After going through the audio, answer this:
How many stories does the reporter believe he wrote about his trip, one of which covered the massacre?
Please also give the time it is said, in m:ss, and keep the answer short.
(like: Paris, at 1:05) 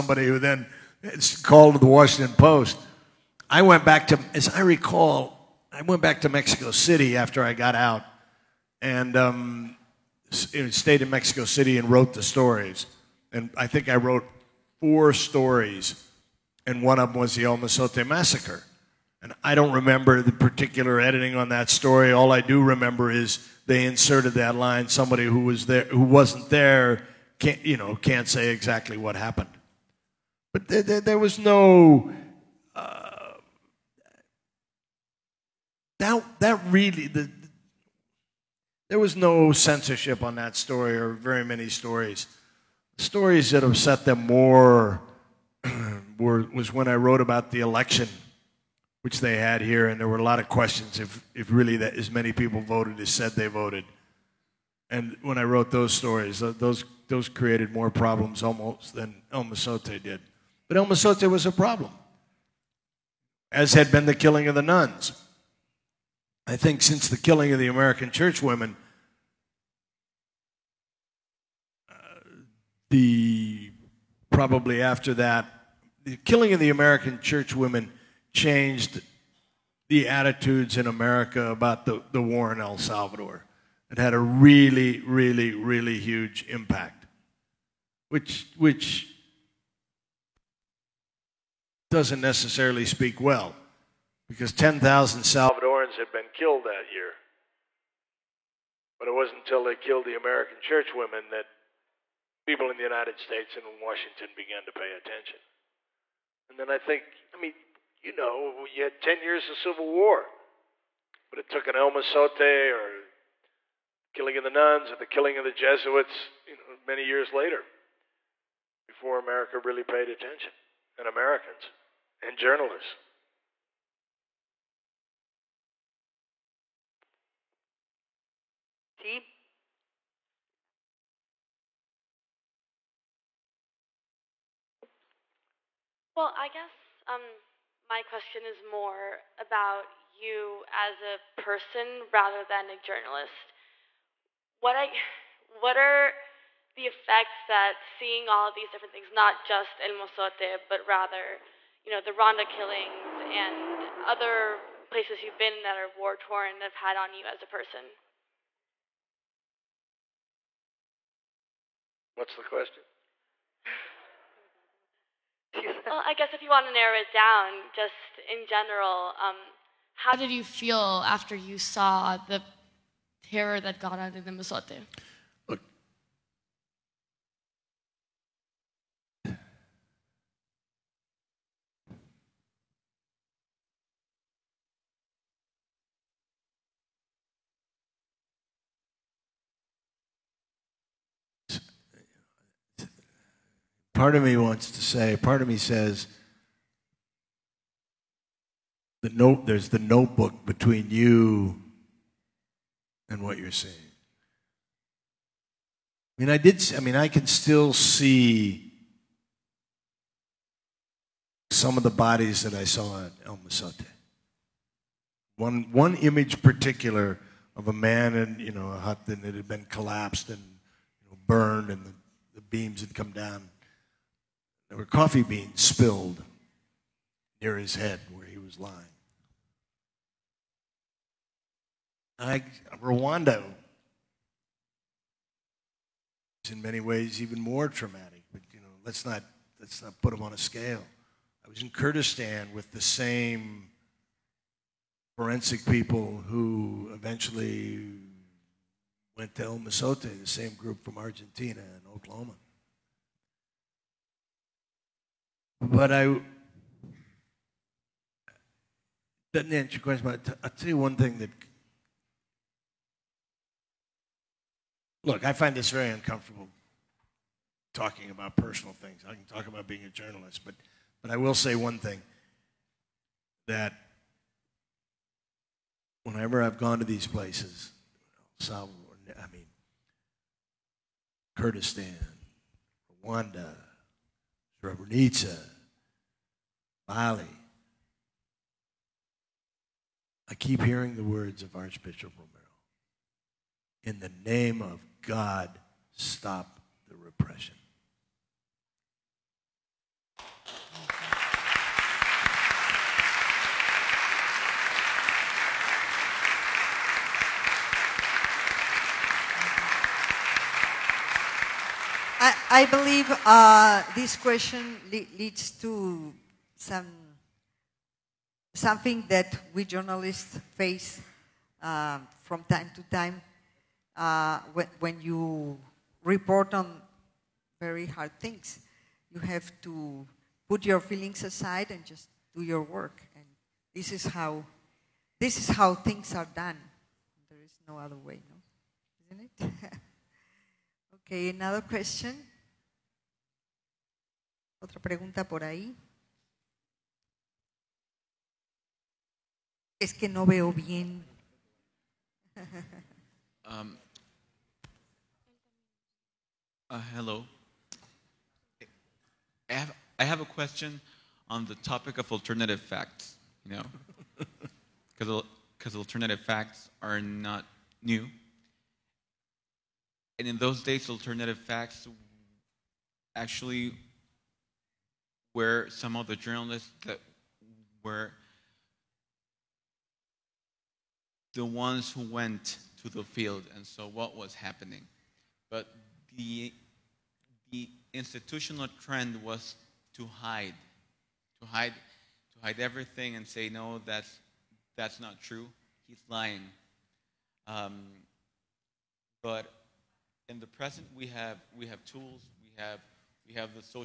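4, at 0:14.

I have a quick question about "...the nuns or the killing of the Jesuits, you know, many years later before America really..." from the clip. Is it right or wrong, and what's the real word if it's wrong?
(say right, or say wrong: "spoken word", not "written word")
right.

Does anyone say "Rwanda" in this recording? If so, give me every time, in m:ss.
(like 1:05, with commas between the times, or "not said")
2:32, 3:52, 4:43.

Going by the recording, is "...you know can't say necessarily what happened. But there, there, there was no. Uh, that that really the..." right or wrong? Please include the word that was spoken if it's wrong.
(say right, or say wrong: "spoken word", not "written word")
wrong: "exactly", not "necessarily".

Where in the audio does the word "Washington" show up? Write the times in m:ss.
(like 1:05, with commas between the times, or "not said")
0:01, 1:43.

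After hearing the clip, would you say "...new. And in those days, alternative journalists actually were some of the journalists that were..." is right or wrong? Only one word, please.
wrong.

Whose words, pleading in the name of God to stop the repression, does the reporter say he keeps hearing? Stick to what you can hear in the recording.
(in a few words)
Archbishop Romero.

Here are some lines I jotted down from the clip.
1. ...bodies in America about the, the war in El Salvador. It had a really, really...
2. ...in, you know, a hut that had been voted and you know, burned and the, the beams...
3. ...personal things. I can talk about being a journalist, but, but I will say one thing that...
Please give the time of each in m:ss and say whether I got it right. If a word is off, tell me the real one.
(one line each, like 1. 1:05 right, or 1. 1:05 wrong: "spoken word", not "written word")
1. 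1:20 wrong: "attitudes", not "bodies"
2. 3:38 wrong: "collapsed", not "voted"
3. 4:28 right.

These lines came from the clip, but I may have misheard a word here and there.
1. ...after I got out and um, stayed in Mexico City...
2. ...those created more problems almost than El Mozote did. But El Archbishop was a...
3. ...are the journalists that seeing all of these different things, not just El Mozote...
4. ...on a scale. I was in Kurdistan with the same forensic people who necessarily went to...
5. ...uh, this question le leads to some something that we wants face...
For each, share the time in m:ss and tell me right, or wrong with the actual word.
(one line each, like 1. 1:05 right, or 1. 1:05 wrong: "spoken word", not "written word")
1. 0:07 right
2. 0:57 wrong: "Mozote", not "Archbishop"
3. 2:25 wrong: "effects", not "journalists"
4. 4:00 wrong: "eventually", not "necessarily"
5. 5:13 wrong: "journalists", not "wants".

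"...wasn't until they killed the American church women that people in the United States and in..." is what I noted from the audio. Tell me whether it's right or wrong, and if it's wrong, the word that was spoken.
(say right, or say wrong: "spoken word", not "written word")
right.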